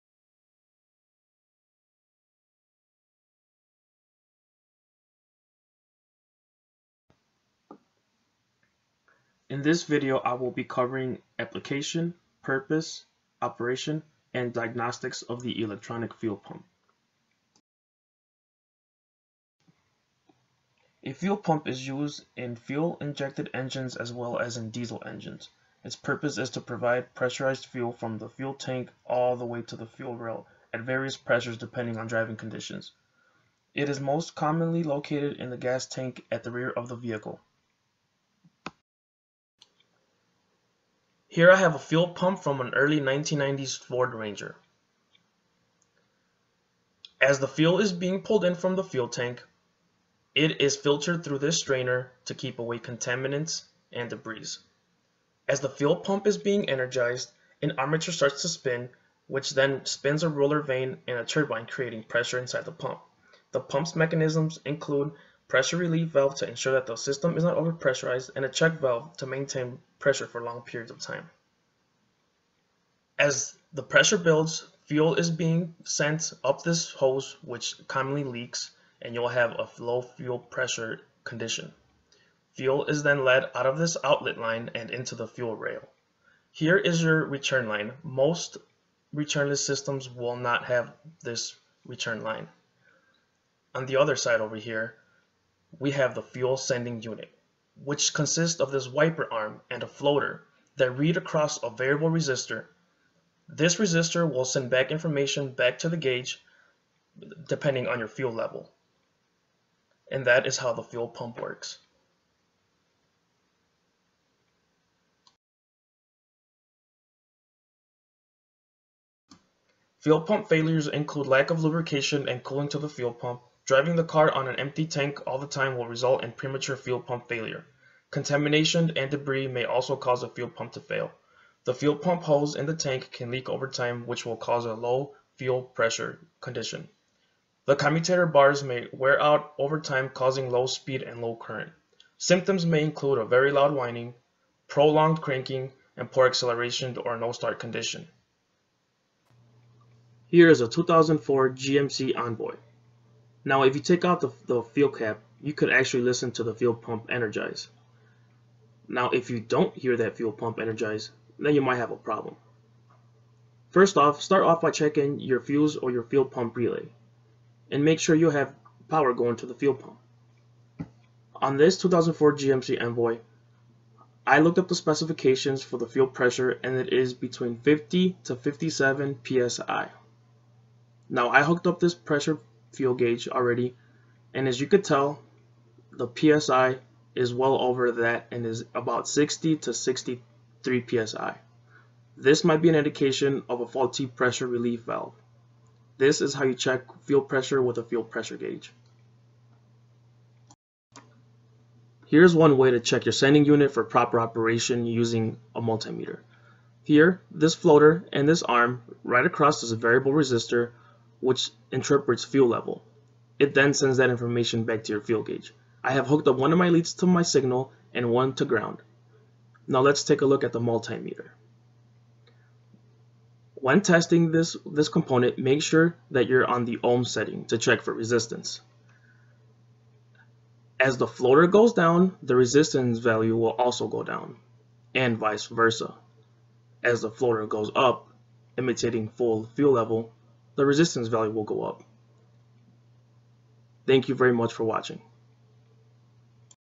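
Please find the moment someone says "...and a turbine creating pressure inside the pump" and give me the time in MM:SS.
01:01.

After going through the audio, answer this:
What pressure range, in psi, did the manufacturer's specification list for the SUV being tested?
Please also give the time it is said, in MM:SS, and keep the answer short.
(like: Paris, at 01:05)
50 to 57 psi, at 02:57.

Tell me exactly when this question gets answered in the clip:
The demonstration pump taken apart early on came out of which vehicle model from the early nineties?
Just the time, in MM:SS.
00:43.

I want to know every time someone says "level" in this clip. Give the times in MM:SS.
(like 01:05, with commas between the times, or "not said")
01:48, 03:32, 03:59.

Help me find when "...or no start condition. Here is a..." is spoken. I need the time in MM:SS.
02:26.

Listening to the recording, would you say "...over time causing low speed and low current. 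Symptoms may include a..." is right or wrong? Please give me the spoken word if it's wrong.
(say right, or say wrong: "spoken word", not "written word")
right.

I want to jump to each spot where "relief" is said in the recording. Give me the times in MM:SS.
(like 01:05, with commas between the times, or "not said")
01:05, 03:14.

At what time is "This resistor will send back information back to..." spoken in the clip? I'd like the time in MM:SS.
01:43.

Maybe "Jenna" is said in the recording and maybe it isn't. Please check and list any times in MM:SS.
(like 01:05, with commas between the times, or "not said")
not said.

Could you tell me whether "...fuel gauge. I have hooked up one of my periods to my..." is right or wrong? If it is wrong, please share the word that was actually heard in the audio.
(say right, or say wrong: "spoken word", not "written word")
wrong: "leads", not "periods".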